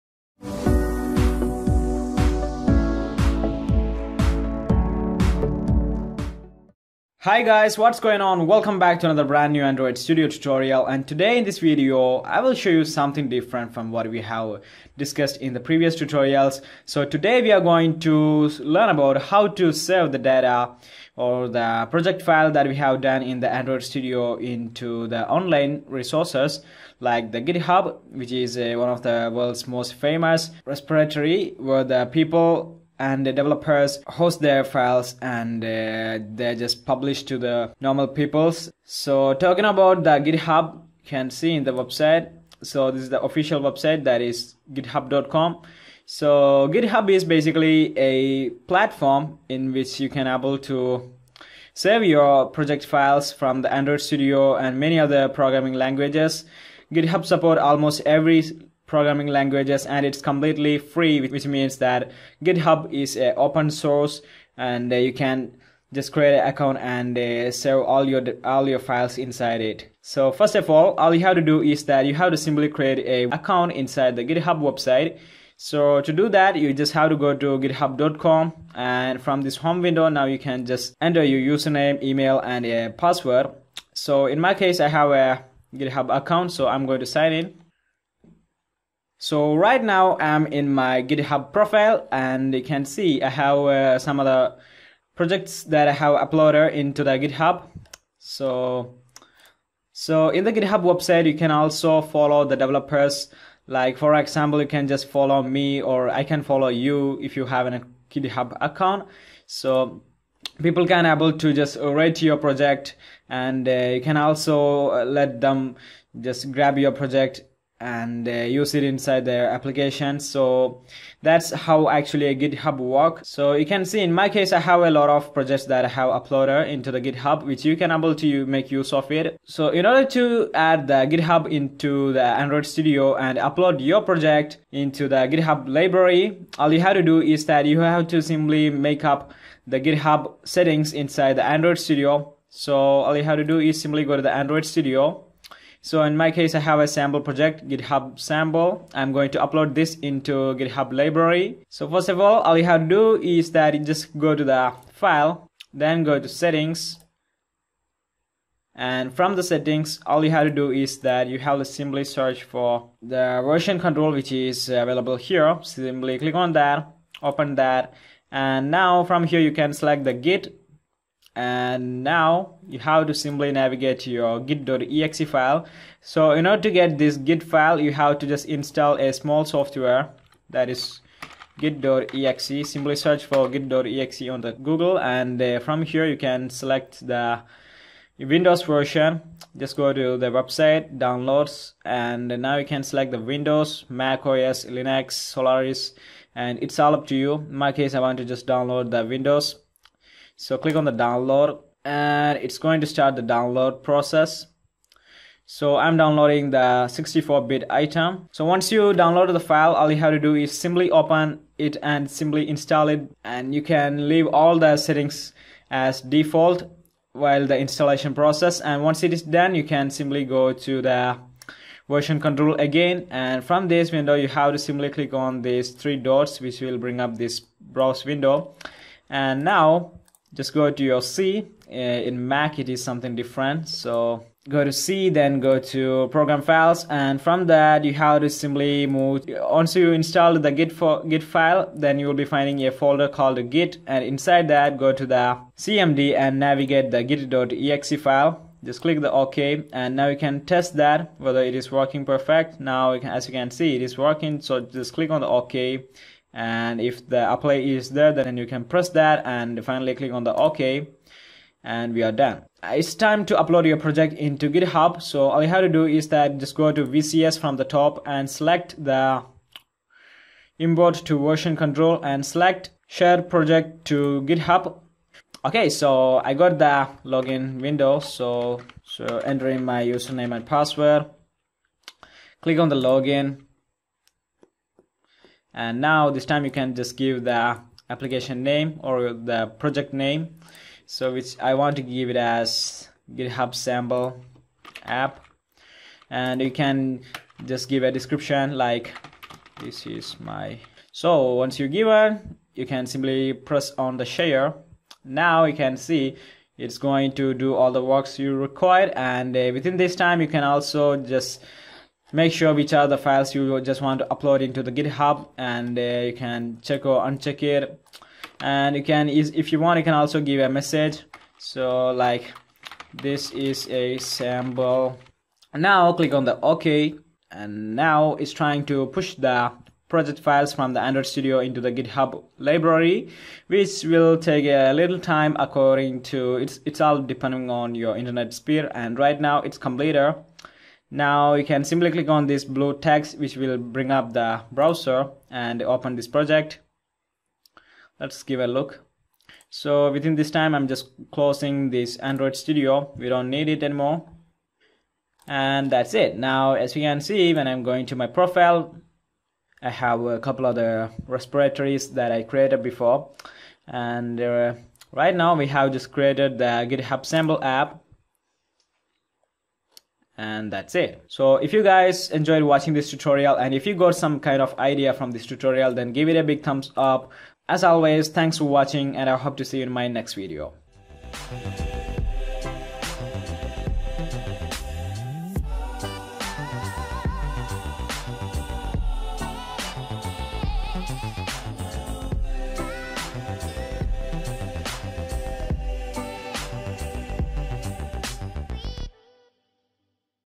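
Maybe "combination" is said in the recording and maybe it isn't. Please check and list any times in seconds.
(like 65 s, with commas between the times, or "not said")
not said.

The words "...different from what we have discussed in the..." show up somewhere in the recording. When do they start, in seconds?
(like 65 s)
13 s.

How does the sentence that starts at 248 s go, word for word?
Just click the OK and now you can test that whether it is working perfect.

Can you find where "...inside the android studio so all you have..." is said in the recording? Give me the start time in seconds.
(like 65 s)
140 s.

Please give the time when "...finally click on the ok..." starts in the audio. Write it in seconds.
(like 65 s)
259 s.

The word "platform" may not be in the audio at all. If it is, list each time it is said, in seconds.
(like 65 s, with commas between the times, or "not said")
48 s.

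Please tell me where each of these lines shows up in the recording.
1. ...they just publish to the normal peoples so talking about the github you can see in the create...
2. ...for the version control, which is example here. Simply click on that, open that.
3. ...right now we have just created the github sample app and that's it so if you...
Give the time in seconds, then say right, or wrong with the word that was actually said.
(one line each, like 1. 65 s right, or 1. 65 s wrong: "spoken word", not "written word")
1. 36 s wrong: "website", not "create"
2. 162 s wrong: "available", not "example"
3. 364 s right.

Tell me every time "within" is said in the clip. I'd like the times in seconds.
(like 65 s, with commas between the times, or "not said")
309 s, 349 s.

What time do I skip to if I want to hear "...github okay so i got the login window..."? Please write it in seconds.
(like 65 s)
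274 s.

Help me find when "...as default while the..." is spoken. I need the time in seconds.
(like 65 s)
215 s.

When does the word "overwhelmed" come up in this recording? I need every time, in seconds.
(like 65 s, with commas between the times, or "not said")
not said.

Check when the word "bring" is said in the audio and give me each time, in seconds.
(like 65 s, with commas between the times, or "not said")
226 s, 343 s.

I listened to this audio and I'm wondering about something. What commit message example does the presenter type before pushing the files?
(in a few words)
this is a sample.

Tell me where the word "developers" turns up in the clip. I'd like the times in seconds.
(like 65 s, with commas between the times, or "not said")
33 s, 102 s.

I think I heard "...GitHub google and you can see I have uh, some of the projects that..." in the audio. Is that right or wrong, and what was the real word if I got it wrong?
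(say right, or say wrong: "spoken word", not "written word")
wrong: "profile", not "google".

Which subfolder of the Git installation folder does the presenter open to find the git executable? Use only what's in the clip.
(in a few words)
CMD.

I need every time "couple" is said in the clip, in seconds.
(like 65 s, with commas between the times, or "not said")
360 s.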